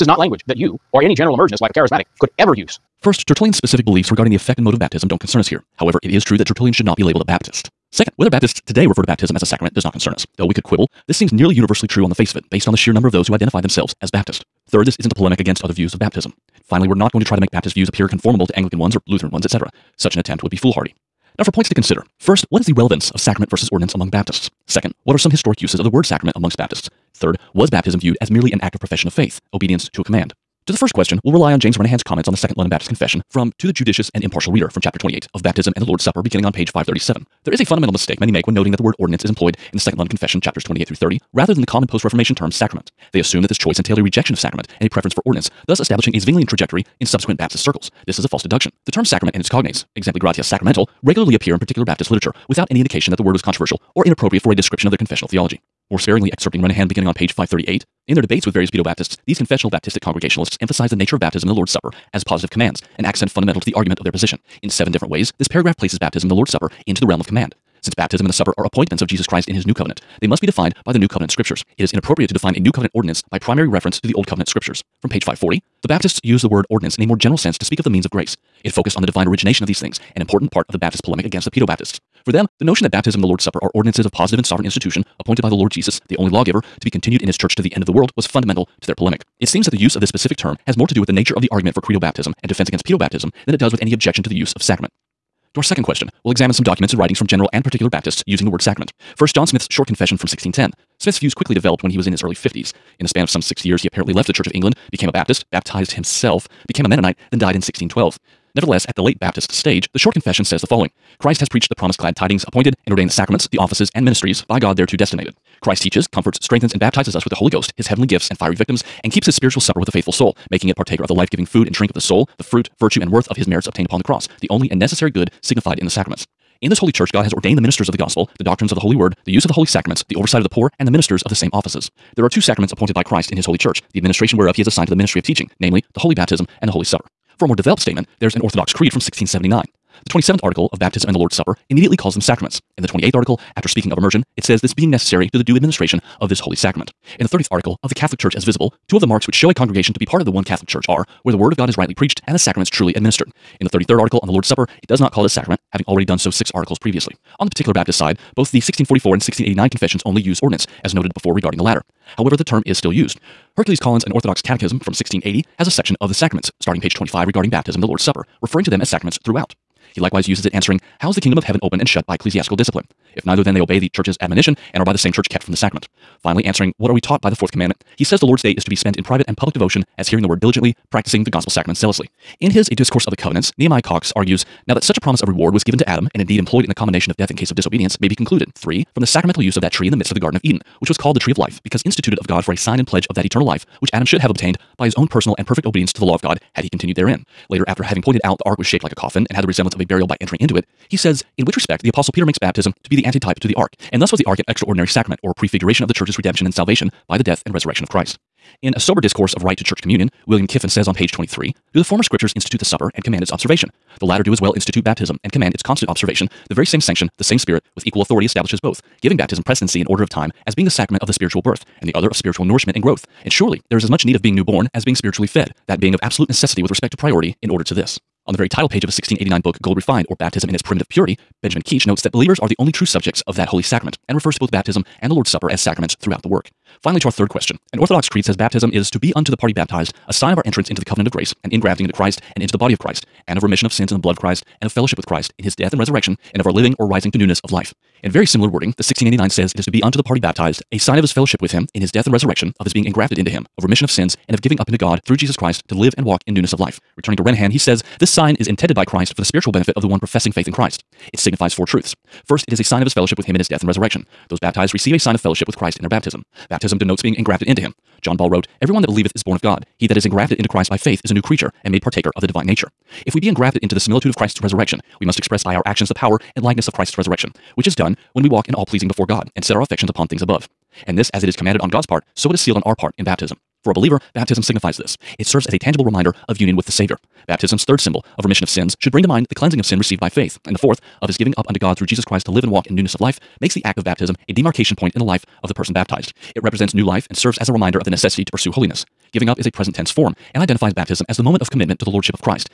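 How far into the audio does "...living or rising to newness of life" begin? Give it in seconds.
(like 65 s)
246 s.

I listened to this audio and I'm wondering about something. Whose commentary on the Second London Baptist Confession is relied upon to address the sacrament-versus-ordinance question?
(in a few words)
James Renihan.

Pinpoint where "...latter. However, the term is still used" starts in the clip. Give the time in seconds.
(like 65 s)
161 s.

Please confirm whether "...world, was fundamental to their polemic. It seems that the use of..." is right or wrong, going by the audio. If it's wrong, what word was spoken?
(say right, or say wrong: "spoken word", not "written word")
right.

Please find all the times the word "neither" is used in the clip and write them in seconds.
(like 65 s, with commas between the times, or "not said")
173 s.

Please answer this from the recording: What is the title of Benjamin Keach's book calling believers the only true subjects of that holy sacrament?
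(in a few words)
Gold Refined.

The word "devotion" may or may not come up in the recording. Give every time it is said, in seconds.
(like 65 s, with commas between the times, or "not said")
179 s.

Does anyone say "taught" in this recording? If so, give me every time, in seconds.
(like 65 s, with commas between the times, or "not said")
176 s.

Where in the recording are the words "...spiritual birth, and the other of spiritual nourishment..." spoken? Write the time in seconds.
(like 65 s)
221 s.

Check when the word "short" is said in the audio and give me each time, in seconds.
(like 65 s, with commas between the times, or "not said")
99 s, 109 s.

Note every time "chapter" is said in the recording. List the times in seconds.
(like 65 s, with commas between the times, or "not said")
34 s, 40 s.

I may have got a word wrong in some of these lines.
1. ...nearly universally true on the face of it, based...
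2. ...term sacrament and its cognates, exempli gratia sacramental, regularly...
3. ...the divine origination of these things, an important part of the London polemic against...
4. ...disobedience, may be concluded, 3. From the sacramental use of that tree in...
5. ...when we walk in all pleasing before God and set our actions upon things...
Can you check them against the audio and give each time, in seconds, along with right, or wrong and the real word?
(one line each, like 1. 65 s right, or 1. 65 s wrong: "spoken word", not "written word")
1. 11 s right
2. 48 s right
3. 79 s wrong: "Baptist", not "London"
4. 187 s right
5. 278 s wrong: "affections", not "actions".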